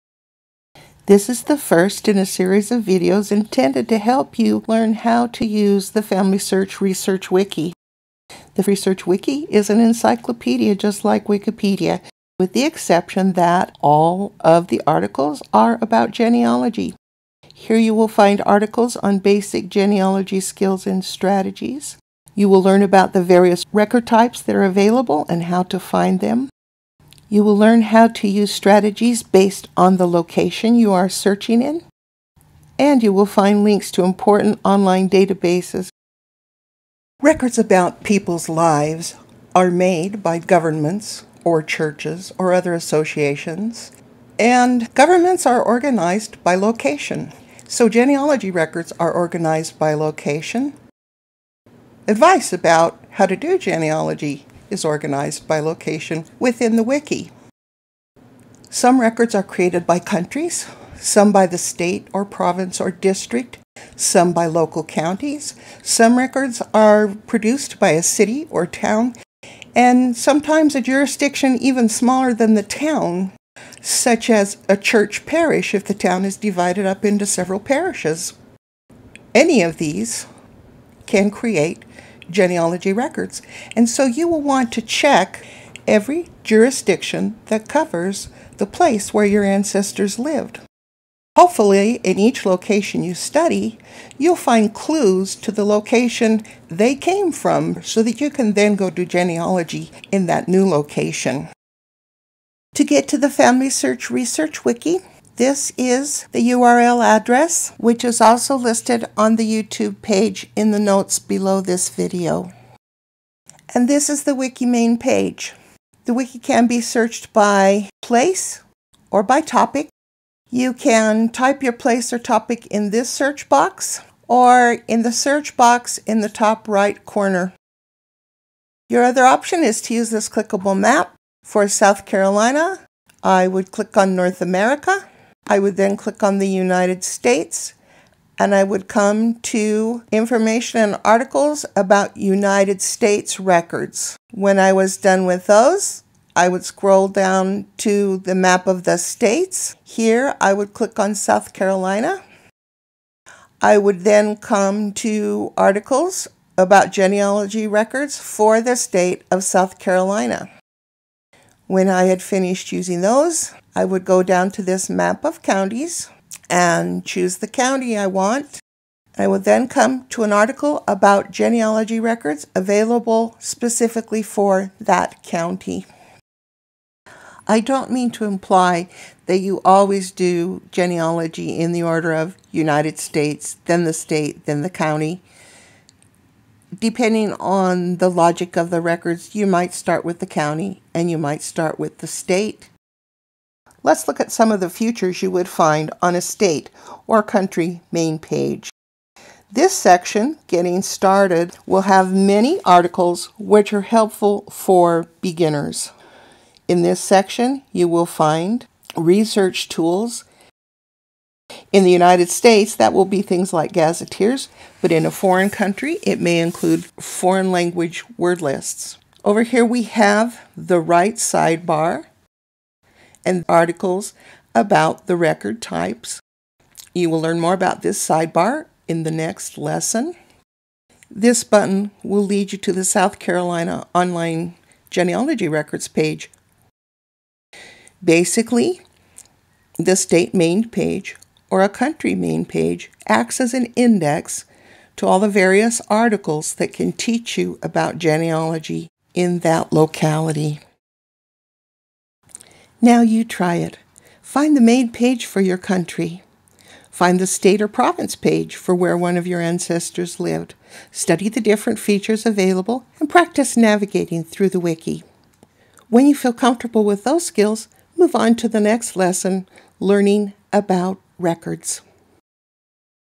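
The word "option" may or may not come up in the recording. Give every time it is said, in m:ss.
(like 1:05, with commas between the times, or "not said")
2:09.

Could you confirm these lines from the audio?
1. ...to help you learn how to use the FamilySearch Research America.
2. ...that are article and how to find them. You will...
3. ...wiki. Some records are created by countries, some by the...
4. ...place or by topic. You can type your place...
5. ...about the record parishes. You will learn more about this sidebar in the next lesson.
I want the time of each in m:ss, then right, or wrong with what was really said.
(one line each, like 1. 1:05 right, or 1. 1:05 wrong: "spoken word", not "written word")
1. 0:03 wrong: "Wiki", not "America"
2. 0:24 wrong: "available", not "article"
3. 0:56 right
4. 1:58 right
5. 3:44 wrong: "types", not "parishes".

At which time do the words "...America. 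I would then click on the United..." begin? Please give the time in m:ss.
2:14.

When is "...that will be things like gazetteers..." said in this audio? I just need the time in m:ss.
3:32.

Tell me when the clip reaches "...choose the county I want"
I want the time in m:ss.
2:47.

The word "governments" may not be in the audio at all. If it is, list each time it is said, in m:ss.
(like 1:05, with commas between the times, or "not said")
0:40, 0:44.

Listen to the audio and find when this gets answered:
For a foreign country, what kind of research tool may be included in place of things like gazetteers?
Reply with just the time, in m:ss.
3:36.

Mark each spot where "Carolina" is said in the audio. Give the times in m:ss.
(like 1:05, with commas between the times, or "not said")
2:12, 2:31, 2:39, 3:53.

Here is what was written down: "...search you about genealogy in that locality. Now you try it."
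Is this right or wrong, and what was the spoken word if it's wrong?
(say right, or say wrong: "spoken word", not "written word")
wrong: "teach", not "search".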